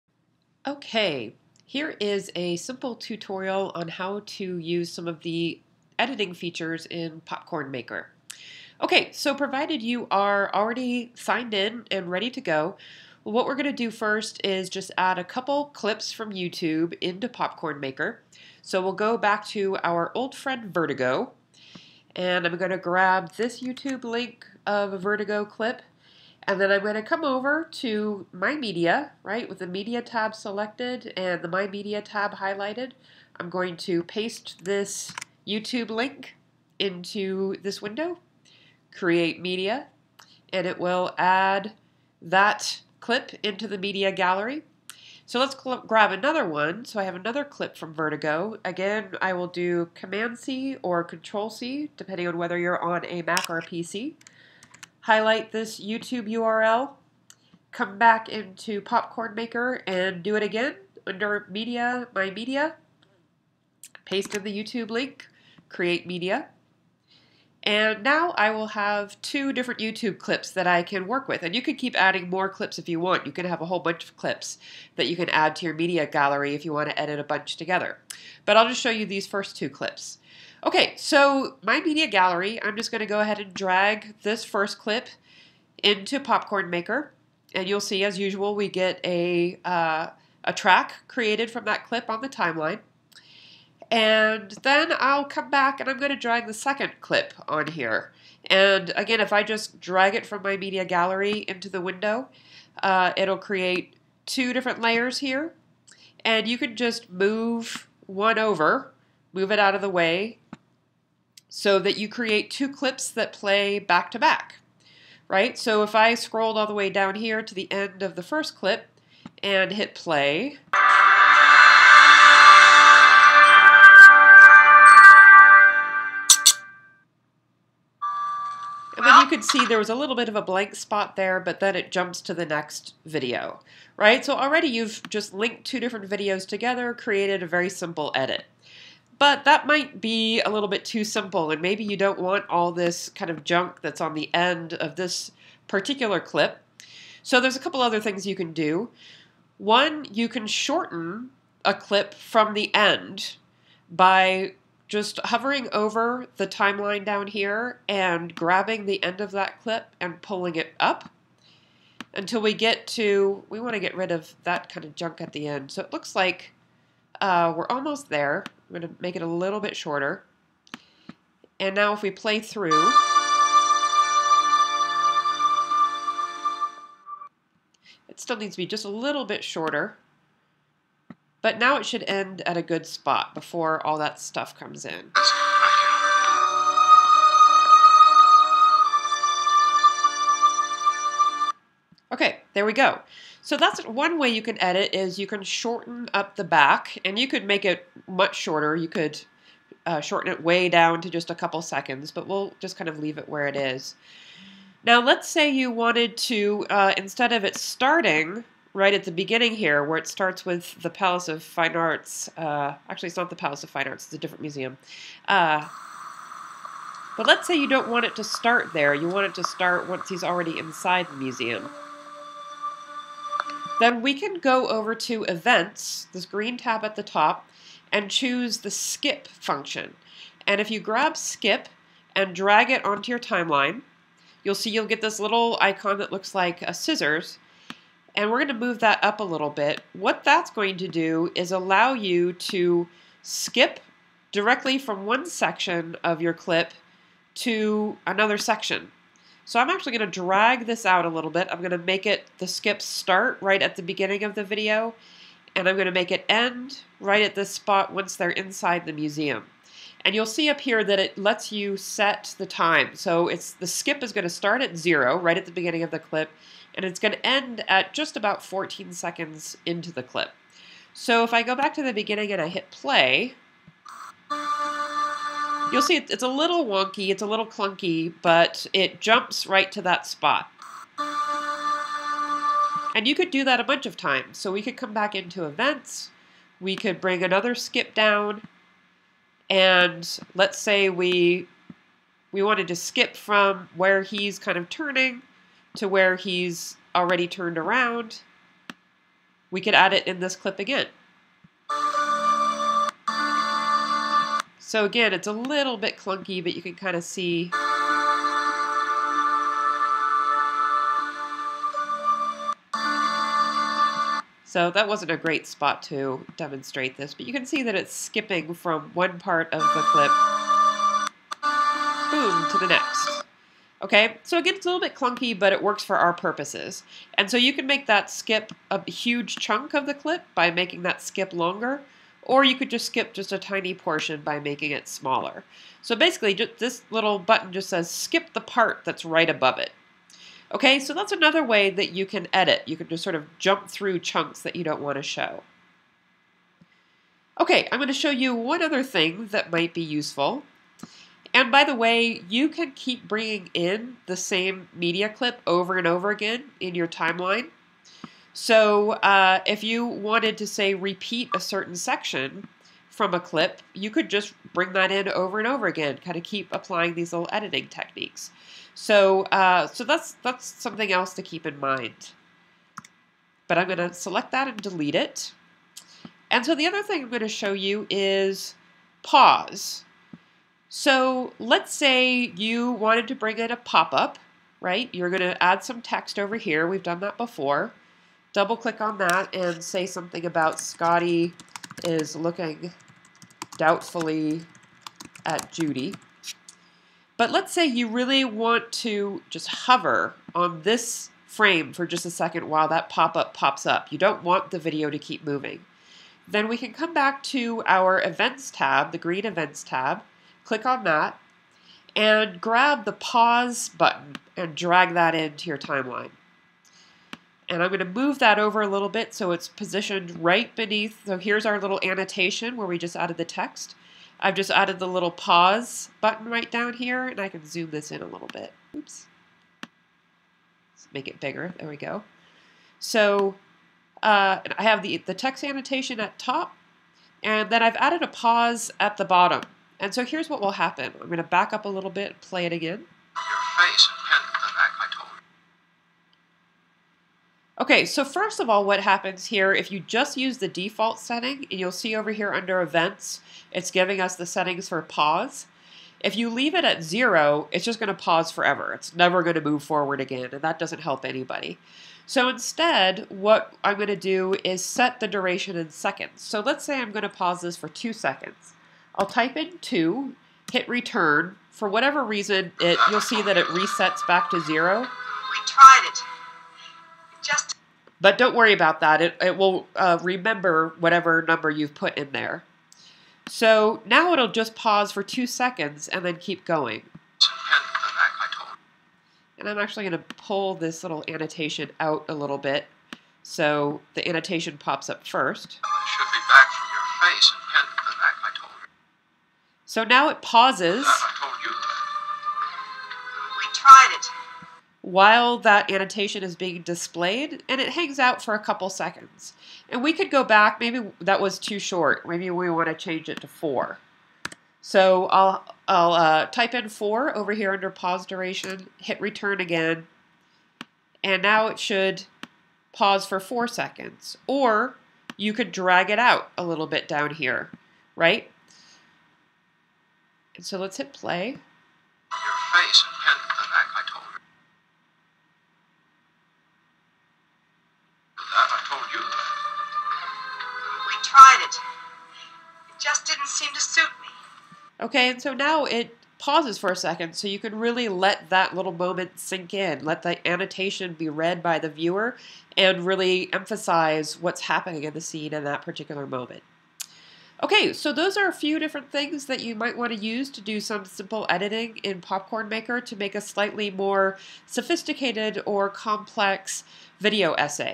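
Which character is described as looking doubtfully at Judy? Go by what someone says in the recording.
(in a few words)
Scotty.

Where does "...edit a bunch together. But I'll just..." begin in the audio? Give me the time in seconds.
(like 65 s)
76 s.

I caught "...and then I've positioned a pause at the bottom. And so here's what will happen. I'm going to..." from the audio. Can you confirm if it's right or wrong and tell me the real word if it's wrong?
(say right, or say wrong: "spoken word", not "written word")
wrong: "added", not "positioned".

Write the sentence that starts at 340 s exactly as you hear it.
Okay, so that's another way that you can edit.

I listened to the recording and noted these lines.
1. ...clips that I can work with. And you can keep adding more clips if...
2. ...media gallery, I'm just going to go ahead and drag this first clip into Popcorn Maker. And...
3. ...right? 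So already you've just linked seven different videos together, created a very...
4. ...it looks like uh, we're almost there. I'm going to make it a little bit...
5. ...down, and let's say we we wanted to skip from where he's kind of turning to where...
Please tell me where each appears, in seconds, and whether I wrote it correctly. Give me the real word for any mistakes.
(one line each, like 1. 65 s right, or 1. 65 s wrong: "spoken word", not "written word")
1. 70 s right
2. 81 s right
3. 133 s wrong: "two", not "seven"
4. 165 s right
5. 287 s right.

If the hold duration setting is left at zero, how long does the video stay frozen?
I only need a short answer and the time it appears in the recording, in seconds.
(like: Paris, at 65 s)
Forever, at 458 s.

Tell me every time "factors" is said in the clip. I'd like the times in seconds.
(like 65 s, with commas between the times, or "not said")
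not said.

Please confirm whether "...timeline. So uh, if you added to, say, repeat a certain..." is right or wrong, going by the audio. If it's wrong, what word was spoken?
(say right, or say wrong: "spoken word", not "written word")
wrong: "wanted", not "added".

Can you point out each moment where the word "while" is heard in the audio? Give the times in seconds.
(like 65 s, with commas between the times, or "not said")
402 s, 504 s.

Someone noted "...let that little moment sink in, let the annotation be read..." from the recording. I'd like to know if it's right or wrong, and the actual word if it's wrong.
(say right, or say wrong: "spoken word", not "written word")
right.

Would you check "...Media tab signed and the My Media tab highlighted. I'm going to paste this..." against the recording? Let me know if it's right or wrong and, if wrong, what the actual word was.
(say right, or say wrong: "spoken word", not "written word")
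wrong: "selected", not "signed".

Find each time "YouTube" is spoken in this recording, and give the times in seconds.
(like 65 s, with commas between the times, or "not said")
16 s, 23 s, 35 s, 55 s, 64 s, 69 s.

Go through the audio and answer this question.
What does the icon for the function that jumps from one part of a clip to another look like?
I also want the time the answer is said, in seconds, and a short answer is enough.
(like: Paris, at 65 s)
Scissors, at 236 s.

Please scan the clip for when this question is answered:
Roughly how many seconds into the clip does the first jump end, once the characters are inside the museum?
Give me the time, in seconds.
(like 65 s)
268 s.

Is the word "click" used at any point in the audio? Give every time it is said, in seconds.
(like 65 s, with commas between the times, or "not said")
388 s, 410 s.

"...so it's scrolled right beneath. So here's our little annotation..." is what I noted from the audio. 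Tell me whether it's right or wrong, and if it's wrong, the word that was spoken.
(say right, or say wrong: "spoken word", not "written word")
wrong: "positioned", not "scrolled".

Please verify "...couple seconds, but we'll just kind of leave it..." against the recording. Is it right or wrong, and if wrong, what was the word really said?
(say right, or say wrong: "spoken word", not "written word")
right.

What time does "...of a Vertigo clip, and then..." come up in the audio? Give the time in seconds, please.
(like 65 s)
24 s.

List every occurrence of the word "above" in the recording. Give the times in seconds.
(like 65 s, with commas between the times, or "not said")
339 s.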